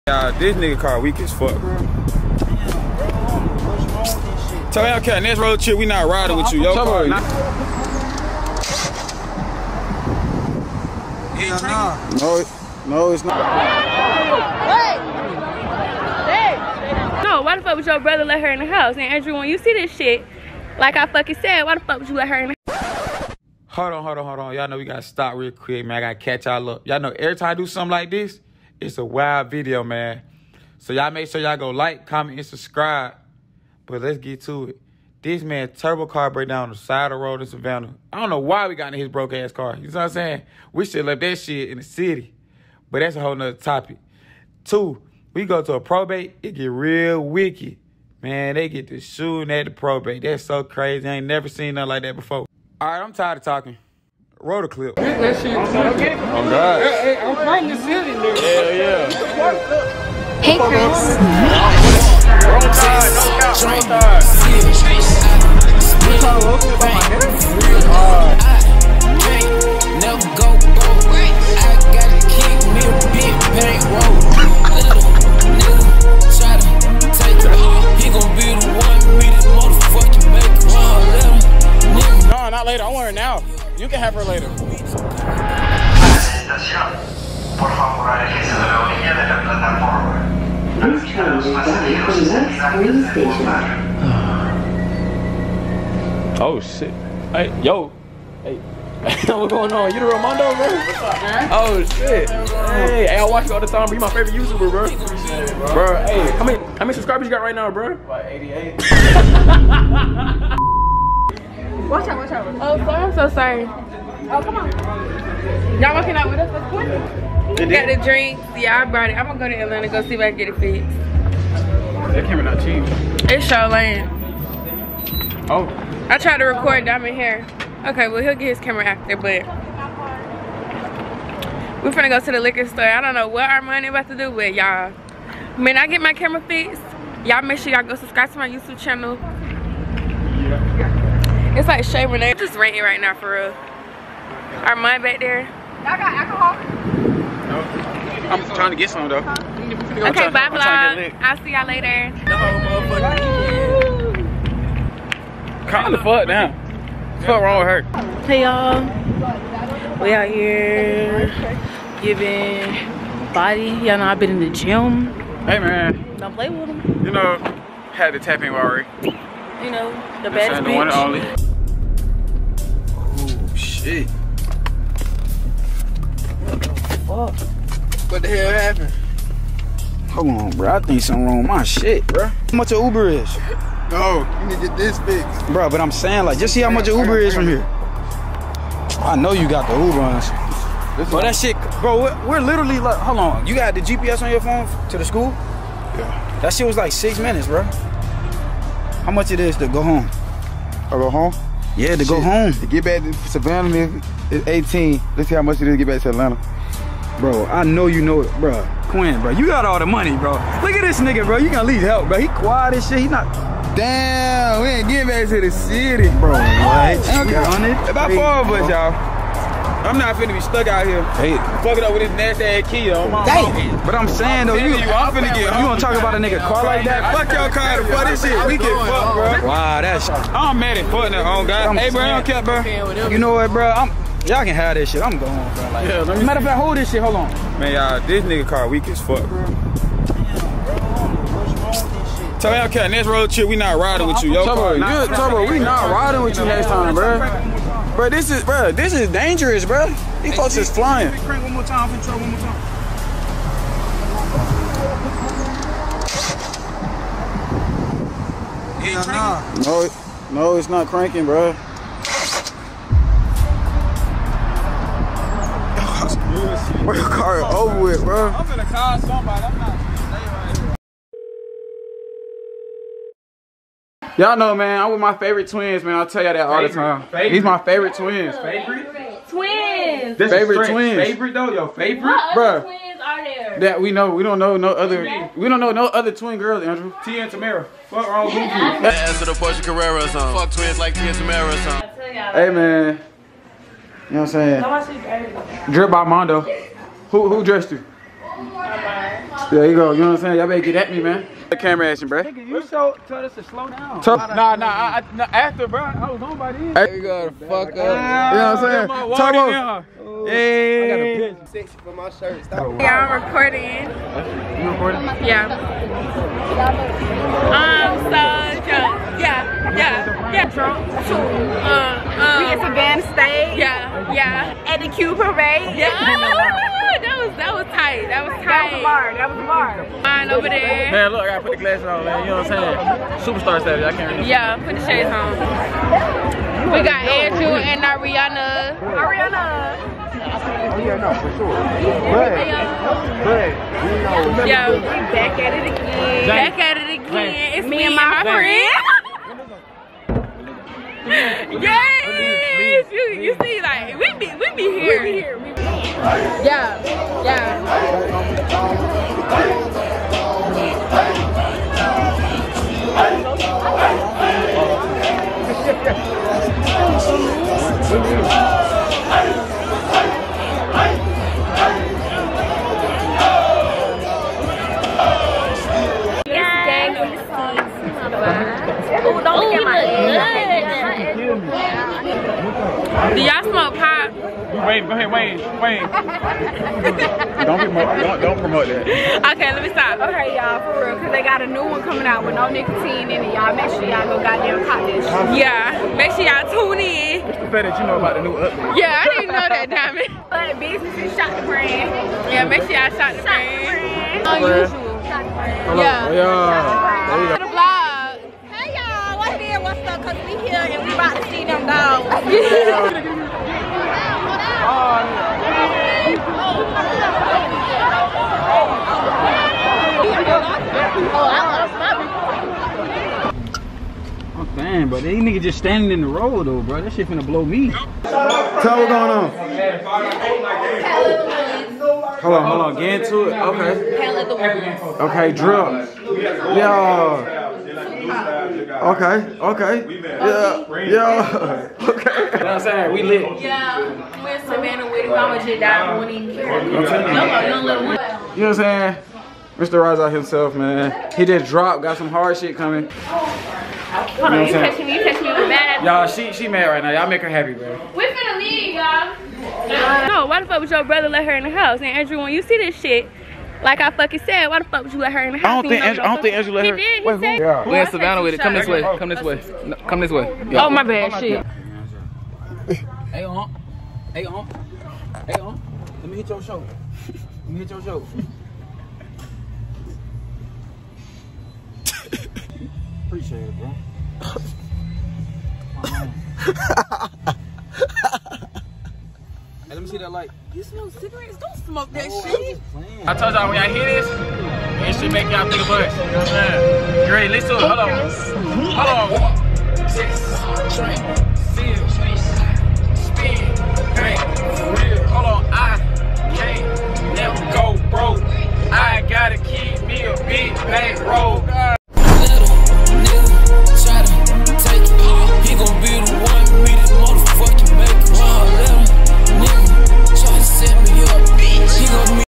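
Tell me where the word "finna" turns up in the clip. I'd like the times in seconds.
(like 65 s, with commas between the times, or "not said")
220 s, 225 s, 427 s, 458 s.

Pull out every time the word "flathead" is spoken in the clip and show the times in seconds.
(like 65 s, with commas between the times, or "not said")
not said.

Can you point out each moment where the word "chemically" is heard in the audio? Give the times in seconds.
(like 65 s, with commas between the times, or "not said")
not said.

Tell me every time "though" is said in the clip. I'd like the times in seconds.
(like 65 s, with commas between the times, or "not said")
149 s, 224 s, 281 s, 426 s.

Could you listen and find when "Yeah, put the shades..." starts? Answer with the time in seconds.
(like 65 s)
334 s.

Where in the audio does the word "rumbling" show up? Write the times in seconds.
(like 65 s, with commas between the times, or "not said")
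not said.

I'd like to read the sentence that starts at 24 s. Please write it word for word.
Y'all know we gotta stop real quick, man.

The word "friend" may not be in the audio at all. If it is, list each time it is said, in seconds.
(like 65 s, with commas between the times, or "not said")
348 s.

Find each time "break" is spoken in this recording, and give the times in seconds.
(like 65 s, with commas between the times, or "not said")
36 s.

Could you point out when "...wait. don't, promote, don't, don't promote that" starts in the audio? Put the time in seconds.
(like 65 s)
385 s.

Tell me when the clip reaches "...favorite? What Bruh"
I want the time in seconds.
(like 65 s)
281 s.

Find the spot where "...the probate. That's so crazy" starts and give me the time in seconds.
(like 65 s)
49 s.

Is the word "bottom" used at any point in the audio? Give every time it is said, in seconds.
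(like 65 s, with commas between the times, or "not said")
not said.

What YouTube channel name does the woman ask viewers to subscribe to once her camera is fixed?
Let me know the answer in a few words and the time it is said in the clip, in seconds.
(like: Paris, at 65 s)
Shay Renee, at 141 s.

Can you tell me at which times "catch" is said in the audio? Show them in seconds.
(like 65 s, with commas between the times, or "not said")
26 s.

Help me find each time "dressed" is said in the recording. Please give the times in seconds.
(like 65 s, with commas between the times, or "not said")
297 s.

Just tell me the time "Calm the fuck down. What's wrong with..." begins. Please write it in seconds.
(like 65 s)
155 s.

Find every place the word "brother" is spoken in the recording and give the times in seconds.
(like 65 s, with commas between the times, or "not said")
17 s, 460 s.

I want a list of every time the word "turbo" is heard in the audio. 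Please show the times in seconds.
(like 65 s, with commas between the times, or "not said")
35 s, 244 s, 309 s.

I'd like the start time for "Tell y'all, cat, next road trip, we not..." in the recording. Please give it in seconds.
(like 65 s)
242 s.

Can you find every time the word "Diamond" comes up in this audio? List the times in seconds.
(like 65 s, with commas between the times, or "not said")
126 s, 399 s.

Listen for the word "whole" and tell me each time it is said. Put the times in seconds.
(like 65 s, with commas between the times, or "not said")
43 s, 152 s.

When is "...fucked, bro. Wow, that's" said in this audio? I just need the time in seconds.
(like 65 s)
228 s.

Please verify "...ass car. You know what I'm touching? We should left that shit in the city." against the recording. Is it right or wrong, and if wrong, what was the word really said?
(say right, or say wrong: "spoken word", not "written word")
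wrong: "saying", not "touching".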